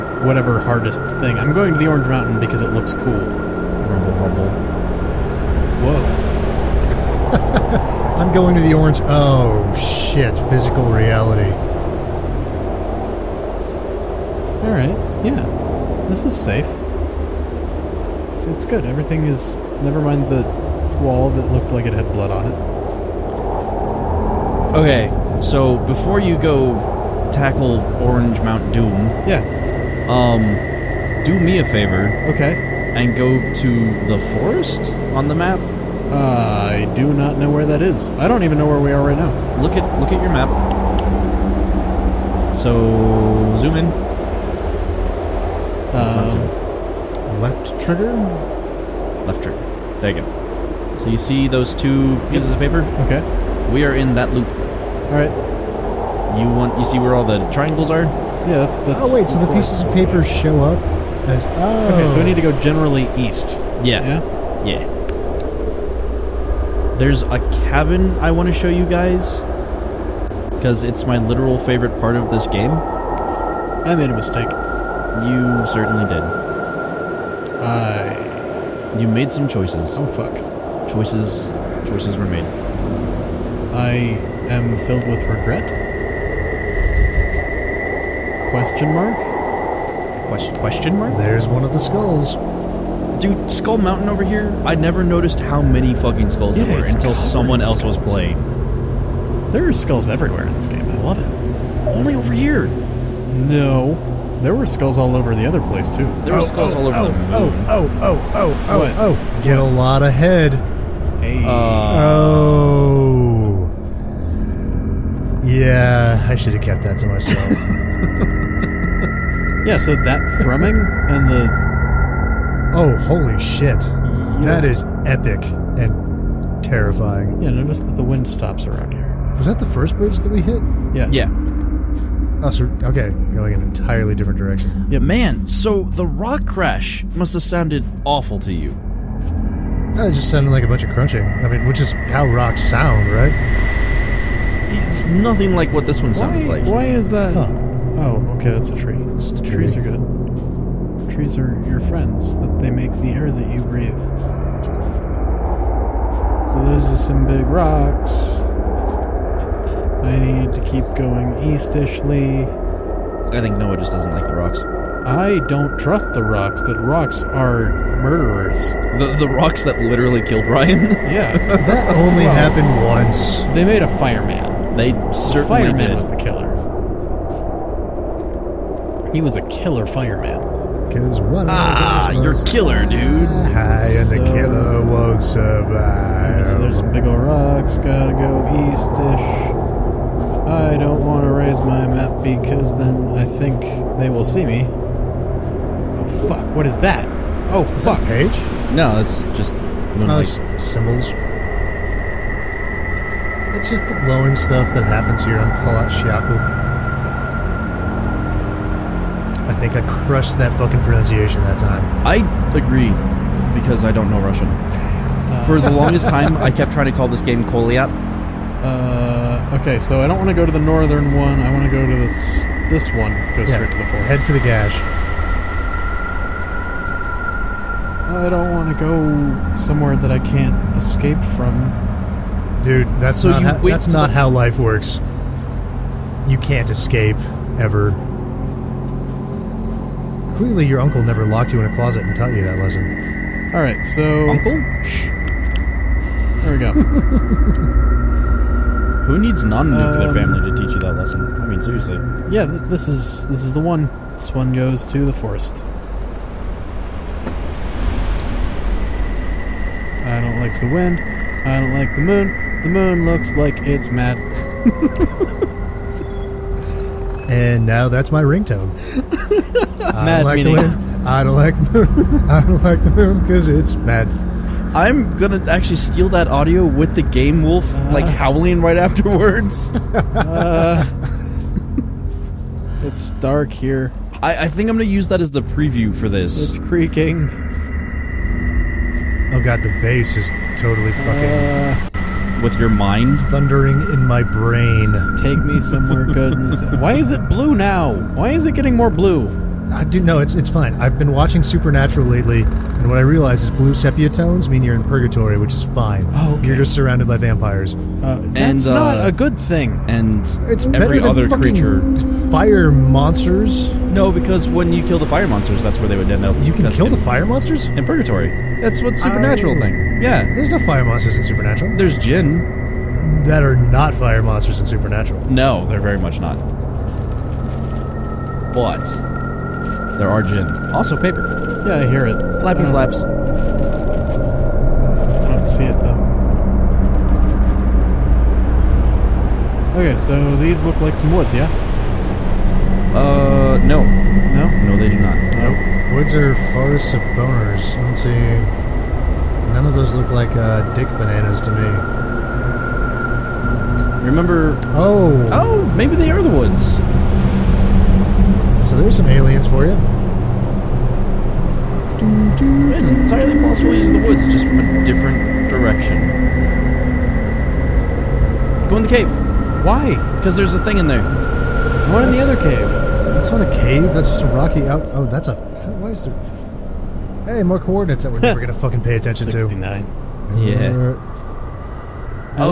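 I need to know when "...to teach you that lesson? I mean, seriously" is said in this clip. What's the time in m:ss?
4:10.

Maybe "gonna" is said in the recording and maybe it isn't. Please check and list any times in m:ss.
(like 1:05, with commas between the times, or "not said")
4:35, 4:44, 6:18.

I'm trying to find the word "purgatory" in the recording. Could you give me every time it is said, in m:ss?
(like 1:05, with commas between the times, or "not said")
5:04, 5:17.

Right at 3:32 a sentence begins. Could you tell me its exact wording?
I agree, because I don't know Russian.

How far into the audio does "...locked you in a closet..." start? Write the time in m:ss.
4:01.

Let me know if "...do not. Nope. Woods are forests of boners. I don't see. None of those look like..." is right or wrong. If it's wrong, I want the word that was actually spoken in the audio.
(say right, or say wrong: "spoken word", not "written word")
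right.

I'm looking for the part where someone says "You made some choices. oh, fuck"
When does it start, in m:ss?
1:18.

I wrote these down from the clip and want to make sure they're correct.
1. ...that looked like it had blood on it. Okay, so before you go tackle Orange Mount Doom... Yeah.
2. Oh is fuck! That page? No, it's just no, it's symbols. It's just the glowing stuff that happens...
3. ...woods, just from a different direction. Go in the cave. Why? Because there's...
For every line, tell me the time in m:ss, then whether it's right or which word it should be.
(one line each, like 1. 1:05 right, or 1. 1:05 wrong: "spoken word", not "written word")
1. 0:21 right
2. 3:17 right
3. 6:03 right.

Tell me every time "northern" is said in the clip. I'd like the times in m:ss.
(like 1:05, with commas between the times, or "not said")
3:40.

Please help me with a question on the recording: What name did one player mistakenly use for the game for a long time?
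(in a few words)
Koliat.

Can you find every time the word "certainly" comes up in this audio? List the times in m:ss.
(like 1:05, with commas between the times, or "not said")
1:15, 2:55.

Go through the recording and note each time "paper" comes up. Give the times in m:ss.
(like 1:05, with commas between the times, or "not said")
0:52, 0:59, 5:30.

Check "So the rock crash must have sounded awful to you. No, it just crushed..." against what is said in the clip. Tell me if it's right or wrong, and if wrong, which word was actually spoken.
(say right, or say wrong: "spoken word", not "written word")
wrong: "sounded", not "crushed".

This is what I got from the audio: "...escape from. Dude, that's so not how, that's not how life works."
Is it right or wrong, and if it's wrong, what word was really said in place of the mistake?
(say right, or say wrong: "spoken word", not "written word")
right.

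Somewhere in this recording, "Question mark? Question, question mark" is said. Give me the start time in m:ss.
1:28.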